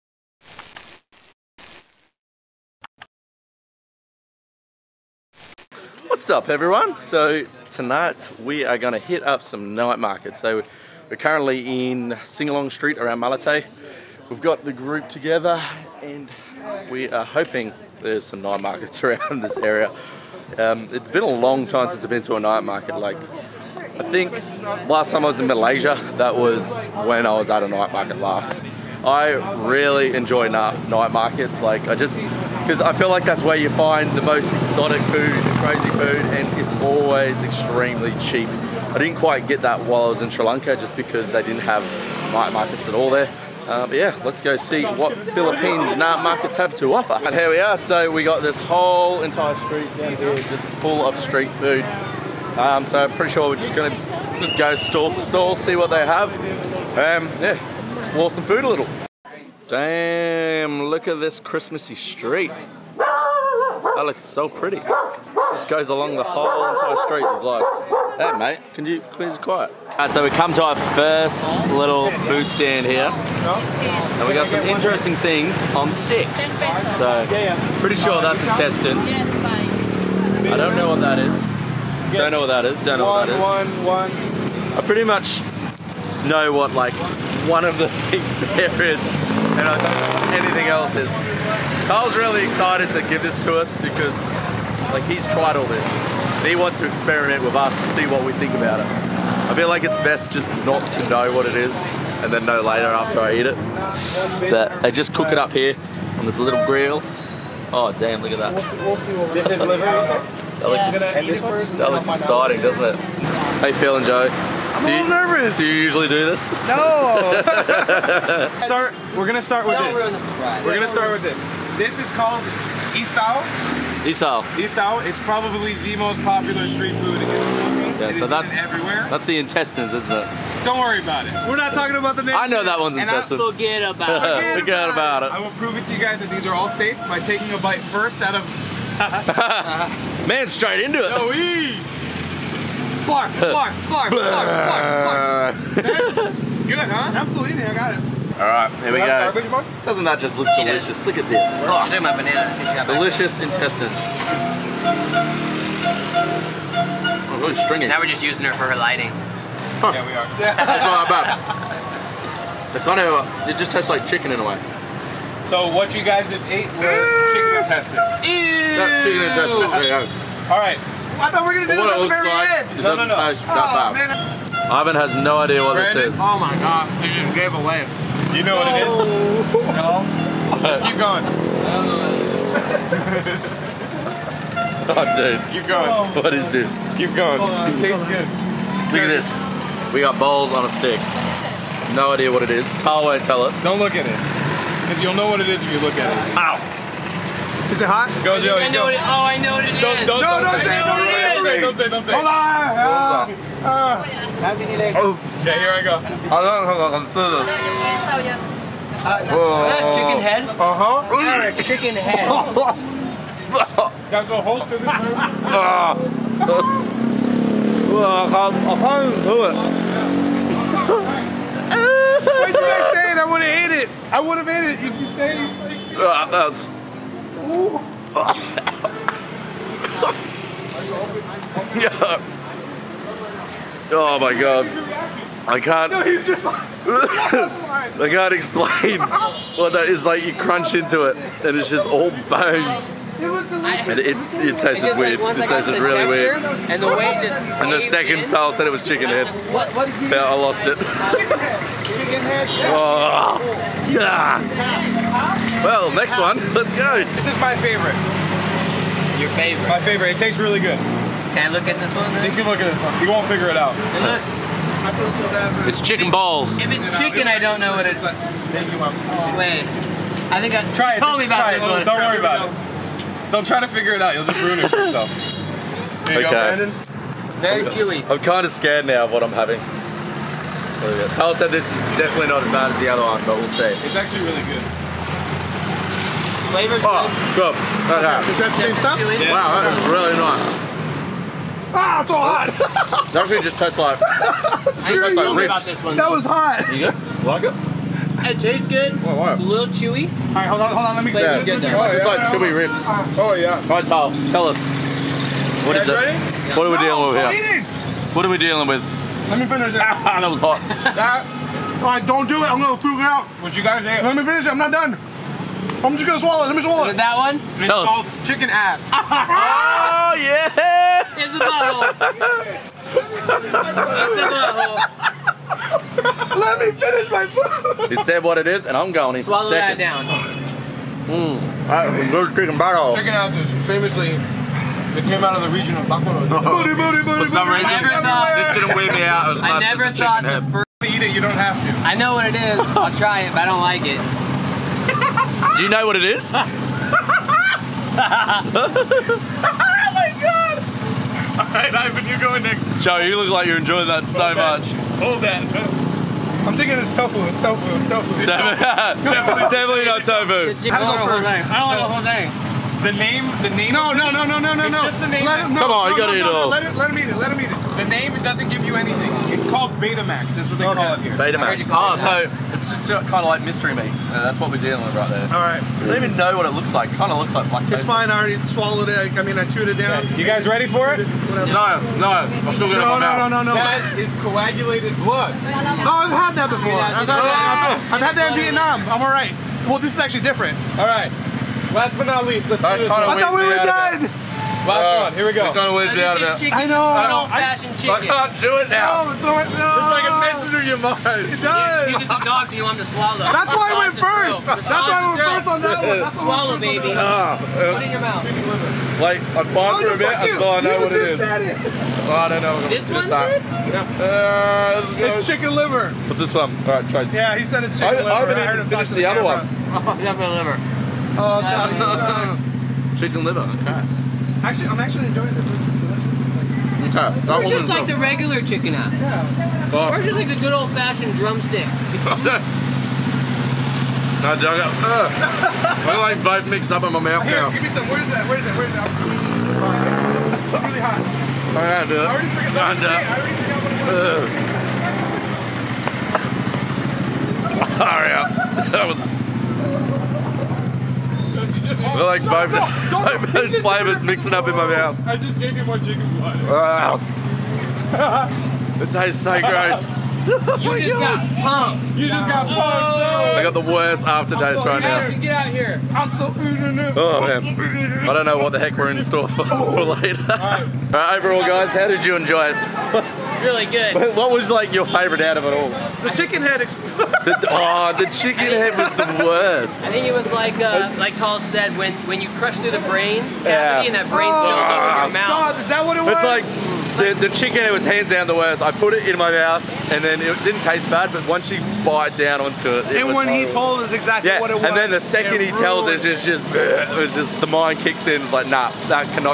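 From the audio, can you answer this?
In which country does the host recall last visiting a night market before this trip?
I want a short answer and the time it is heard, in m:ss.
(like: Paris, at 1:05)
Malaysia, at 0:25.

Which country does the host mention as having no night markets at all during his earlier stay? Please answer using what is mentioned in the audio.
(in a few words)
Sri Lanka.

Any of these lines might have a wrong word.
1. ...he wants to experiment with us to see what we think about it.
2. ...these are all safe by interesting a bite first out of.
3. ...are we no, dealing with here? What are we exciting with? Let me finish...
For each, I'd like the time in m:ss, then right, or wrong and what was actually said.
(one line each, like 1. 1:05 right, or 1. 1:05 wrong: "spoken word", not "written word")
1. 1:36 right
2. 2:16 wrong: "taking", not "interesting"
3. 5:06 wrong: "dealing", not "exciting".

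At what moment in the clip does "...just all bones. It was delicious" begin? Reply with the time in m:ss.
4:01.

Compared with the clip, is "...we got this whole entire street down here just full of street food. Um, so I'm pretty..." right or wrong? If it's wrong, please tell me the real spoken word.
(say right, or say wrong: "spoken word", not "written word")
right.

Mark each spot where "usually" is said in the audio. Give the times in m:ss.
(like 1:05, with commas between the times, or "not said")
1:55.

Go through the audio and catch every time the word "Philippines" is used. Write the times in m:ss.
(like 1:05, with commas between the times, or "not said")
0:45, 2:07.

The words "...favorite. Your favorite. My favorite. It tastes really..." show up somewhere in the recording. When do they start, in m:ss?
4:17.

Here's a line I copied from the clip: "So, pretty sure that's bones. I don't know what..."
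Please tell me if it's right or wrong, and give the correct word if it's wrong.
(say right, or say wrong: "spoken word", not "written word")
wrong: "intestines", not "bones".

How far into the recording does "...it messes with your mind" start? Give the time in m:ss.
6:40.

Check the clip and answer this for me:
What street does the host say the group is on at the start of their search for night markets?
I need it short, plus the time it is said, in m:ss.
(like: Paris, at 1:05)
Singalong Street, at 0:12.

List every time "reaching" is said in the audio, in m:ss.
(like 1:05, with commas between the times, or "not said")
not said.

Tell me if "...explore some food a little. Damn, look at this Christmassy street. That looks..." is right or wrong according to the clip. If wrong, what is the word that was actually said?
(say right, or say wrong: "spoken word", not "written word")
right.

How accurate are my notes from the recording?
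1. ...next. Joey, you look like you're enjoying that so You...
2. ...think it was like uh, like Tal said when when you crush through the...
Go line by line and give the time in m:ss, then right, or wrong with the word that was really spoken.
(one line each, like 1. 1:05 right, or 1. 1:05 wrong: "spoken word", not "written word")
1. 5:52 wrong: "Hold", not "You"
2. 7:59 right.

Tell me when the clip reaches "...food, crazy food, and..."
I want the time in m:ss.
0:35.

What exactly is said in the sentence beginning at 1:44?
That I just cook it up here on this little grill.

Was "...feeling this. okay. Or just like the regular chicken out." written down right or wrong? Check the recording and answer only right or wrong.
wrong.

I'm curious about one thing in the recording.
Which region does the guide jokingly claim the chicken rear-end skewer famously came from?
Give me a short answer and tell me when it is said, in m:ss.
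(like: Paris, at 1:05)
Bakuro, at 5:35.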